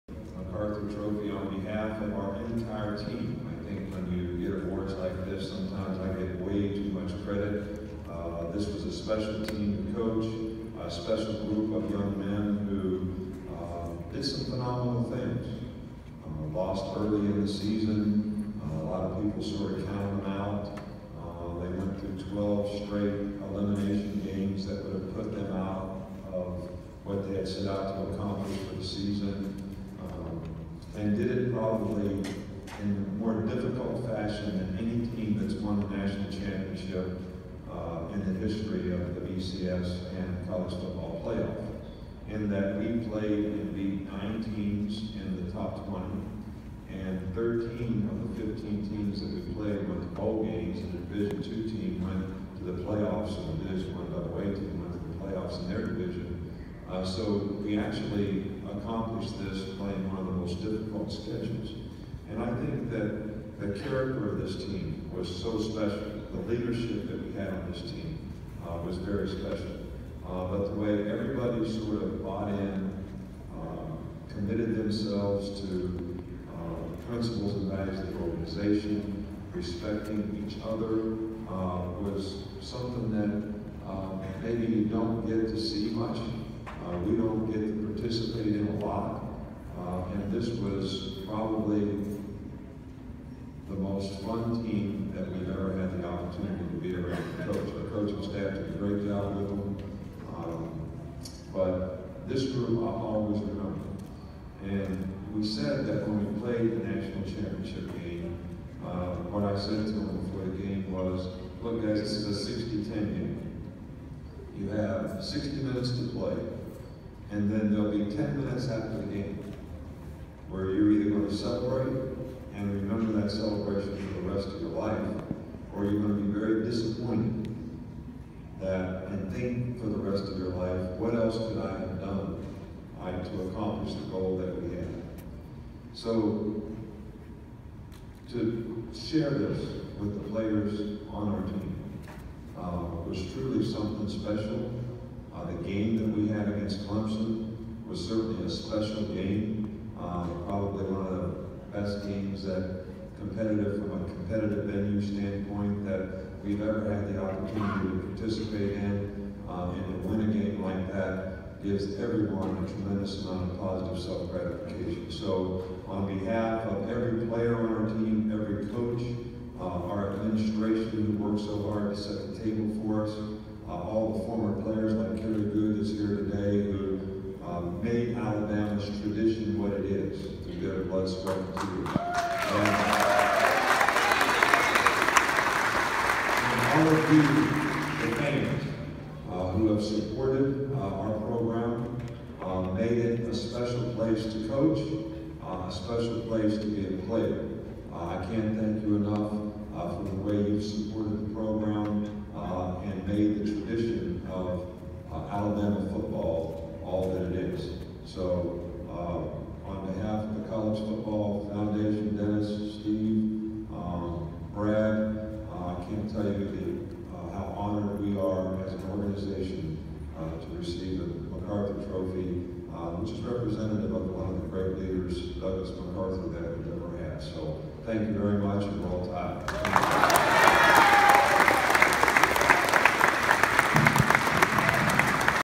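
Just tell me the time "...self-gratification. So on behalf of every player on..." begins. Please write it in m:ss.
2:44.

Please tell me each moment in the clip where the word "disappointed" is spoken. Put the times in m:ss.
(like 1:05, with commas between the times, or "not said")
2:06.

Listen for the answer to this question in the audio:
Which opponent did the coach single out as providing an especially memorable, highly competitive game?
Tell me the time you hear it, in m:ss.
2:26.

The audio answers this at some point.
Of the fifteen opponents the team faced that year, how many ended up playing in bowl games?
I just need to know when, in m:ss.
0:47.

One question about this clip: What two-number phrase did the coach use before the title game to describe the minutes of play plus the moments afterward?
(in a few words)
60-10.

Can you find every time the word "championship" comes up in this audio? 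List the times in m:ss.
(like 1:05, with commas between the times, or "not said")
0:36, 1:47.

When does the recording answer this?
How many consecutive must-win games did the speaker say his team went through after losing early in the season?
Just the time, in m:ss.
0:22.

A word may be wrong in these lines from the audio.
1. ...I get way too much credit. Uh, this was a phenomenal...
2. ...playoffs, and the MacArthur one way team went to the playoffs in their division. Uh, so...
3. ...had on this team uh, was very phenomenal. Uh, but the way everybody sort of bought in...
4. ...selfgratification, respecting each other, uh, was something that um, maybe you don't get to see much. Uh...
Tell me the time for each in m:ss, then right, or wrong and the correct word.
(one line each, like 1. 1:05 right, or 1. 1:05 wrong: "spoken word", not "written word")
1. 0:05 wrong: "special", not "phenomenal"
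2. 0:52 wrong: "Division", not "MacArthur"
3. 1:07 wrong: "special", not "phenomenal"
4. 1:18 wrong: "organization", not "selfgratification".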